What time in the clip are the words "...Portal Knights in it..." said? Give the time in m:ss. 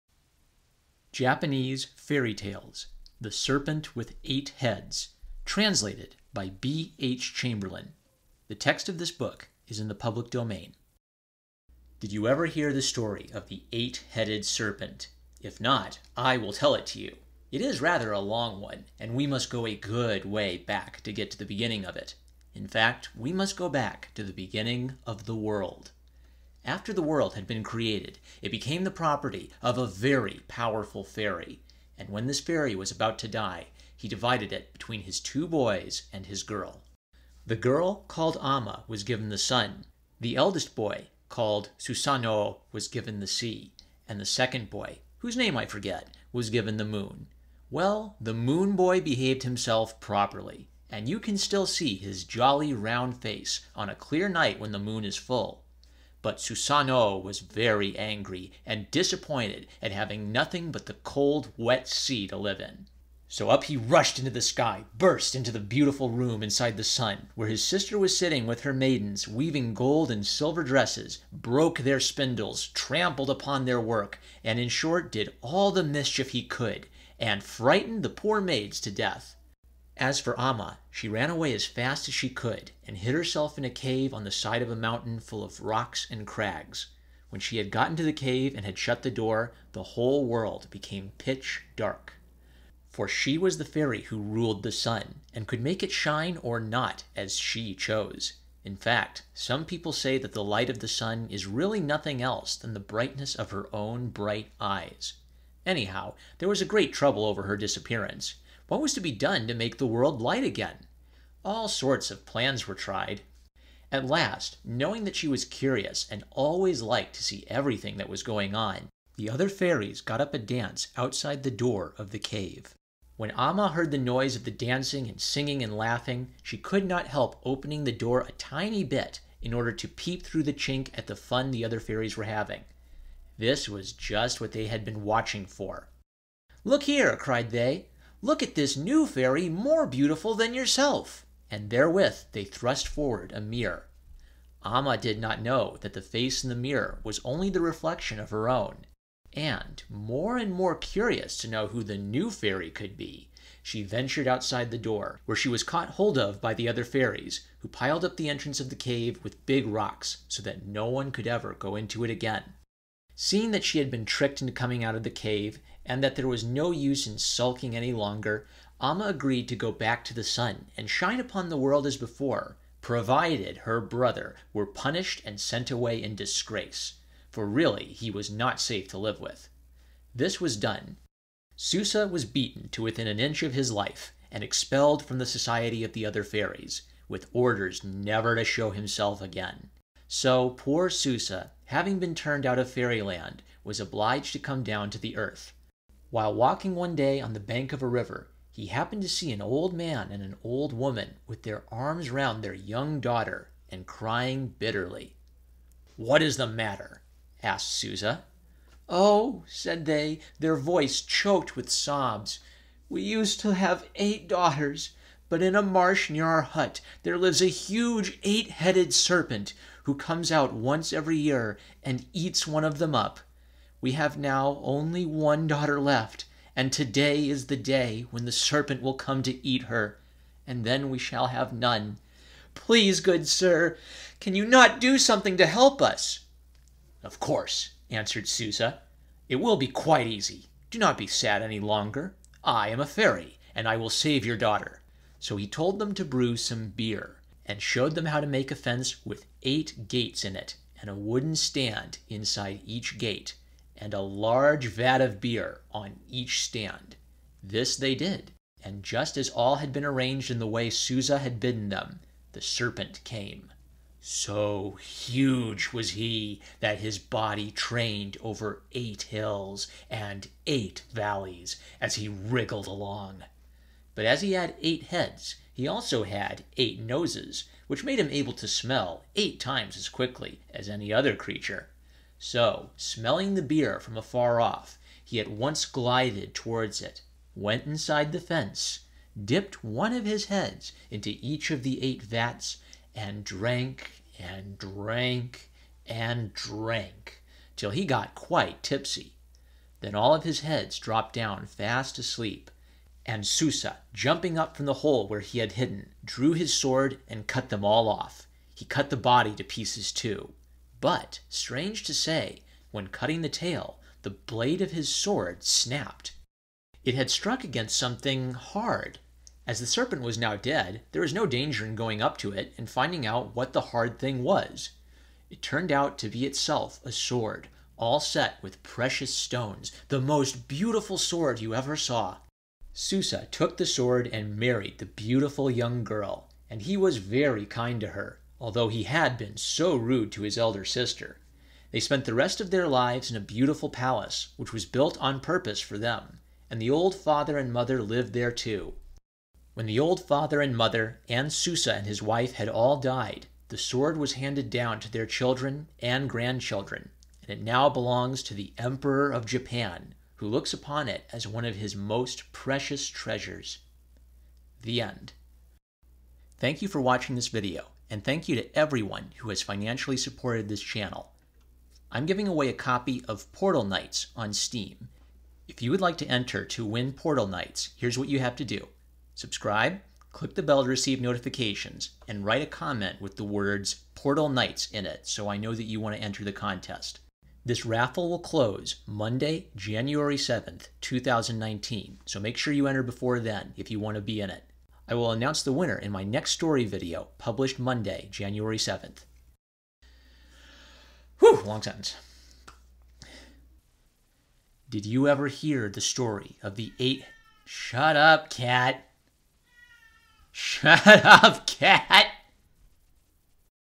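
6:23.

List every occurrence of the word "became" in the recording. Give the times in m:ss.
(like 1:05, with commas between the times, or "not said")
0:28, 1:30.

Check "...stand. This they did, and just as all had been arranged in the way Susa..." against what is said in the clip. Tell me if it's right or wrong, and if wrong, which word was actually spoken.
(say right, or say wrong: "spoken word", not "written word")
right.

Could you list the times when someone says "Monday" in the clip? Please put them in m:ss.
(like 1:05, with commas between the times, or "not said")
6:28, 6:37.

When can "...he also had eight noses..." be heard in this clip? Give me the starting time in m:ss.
4:35.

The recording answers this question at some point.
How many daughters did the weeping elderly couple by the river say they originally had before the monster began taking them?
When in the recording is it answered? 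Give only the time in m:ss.
3:33.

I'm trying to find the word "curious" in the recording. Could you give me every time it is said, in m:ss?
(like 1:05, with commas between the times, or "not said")
1:55, 2:30.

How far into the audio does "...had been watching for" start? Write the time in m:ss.
2:14.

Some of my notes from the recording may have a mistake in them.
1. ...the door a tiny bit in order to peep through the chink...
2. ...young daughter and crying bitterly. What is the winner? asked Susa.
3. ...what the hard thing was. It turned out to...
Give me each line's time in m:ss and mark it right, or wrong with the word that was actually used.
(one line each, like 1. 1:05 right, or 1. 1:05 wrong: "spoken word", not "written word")
1. 2:07 right
2. 3:22 wrong: "matter", not "winner"
3. 5:23 right.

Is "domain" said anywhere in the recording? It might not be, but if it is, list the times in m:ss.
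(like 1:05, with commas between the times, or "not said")
0:10.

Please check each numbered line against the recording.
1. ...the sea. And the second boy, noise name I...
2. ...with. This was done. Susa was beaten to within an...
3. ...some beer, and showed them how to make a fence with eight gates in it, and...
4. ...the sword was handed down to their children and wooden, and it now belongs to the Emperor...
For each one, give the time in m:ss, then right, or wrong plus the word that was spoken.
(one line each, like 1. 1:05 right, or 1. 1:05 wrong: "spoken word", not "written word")
1. 0:43 wrong: "whose", not "noise"
2. 2:59 right
3. 4:06 right
4. 5:53 wrong: "grandchildren", not "wooden".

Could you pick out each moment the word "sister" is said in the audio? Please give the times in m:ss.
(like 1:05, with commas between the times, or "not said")
1:07, 5:40.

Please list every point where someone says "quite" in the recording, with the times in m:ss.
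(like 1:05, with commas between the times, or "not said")
3:59, 4:58.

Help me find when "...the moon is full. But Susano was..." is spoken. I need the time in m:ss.
0:54.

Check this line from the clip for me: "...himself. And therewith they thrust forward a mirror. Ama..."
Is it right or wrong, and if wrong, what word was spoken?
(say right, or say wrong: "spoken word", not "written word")
wrong: "yourself", not "himself".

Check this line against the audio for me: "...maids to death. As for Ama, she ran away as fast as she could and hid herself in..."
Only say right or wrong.
right.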